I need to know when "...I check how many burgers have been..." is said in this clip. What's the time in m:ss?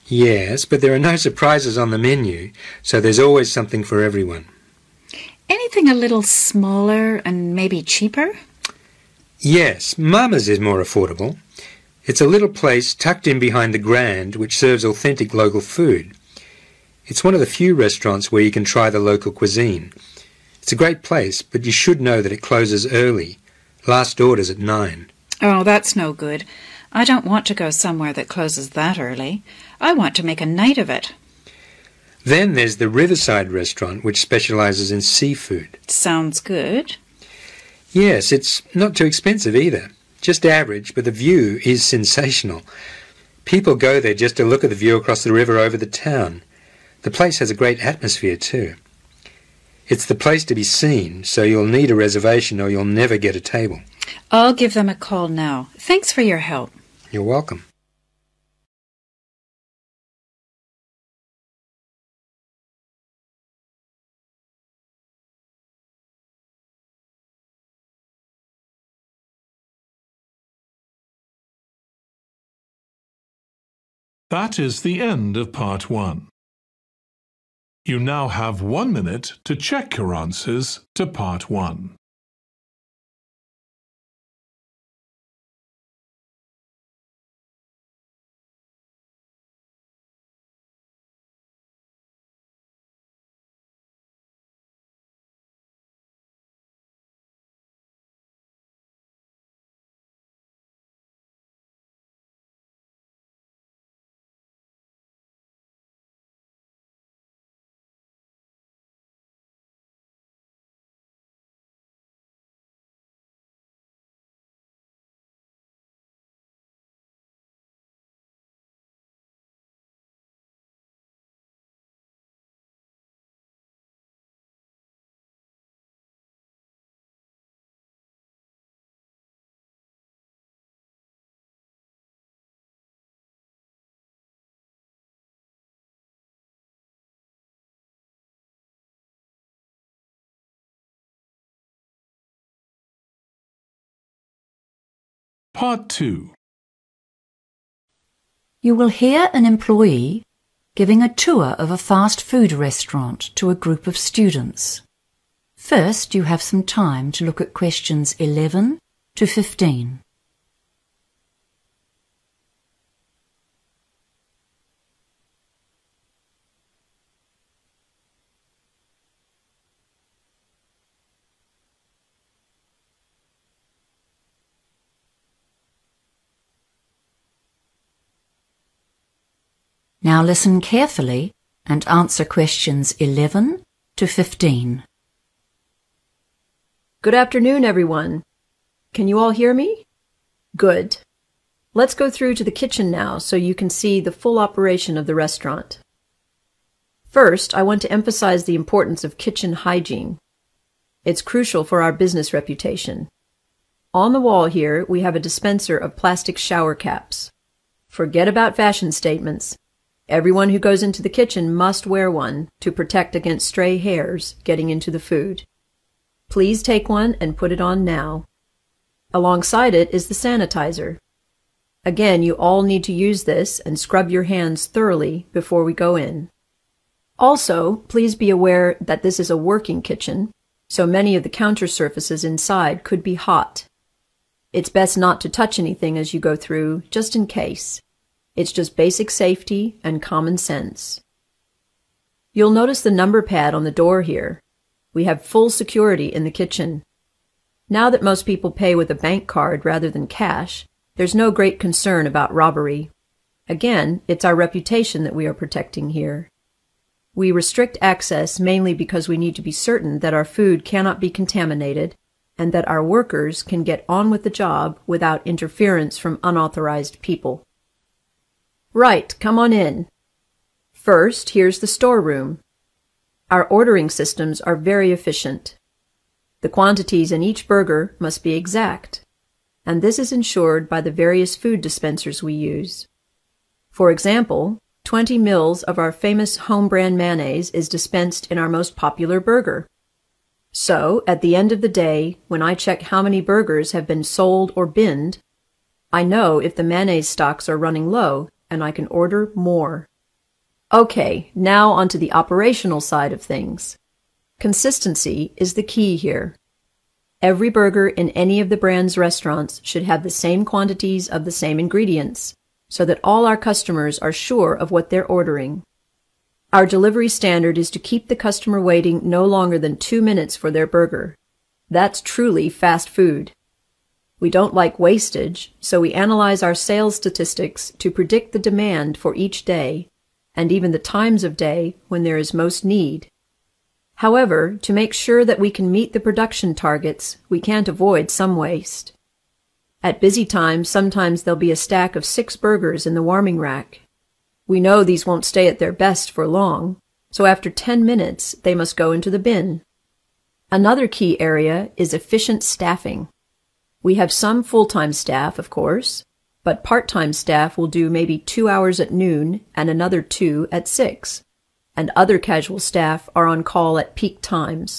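4:52.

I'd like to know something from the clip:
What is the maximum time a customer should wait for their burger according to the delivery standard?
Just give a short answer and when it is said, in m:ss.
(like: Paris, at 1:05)
2 minutes, at 5:19.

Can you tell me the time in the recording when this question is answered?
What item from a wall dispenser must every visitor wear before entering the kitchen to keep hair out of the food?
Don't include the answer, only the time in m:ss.
3:25.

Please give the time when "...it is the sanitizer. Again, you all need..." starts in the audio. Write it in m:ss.
3:39.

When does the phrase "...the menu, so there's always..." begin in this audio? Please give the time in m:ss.
0:01.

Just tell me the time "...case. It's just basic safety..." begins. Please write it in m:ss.
3:57.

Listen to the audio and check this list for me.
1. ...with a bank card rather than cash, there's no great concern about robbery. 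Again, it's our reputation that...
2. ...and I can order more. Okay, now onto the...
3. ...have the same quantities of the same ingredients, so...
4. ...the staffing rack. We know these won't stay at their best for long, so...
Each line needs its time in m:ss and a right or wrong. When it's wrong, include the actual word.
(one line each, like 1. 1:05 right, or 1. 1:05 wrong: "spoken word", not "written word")
1. 4:08 right
2. 4:58 right
3. 5:09 right
4. 5:42 wrong: "warming", not "staffing".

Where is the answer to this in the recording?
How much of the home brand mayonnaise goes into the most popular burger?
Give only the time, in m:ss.
4:44.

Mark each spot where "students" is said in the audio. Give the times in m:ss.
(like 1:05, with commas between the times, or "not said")
2:33.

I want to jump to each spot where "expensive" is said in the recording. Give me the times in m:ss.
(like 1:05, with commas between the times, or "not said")
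0:39.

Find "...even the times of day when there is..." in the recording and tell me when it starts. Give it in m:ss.
5:30.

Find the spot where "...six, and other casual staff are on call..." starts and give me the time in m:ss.
6:00.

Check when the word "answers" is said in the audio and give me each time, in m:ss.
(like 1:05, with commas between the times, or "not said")
1:20, 3:01.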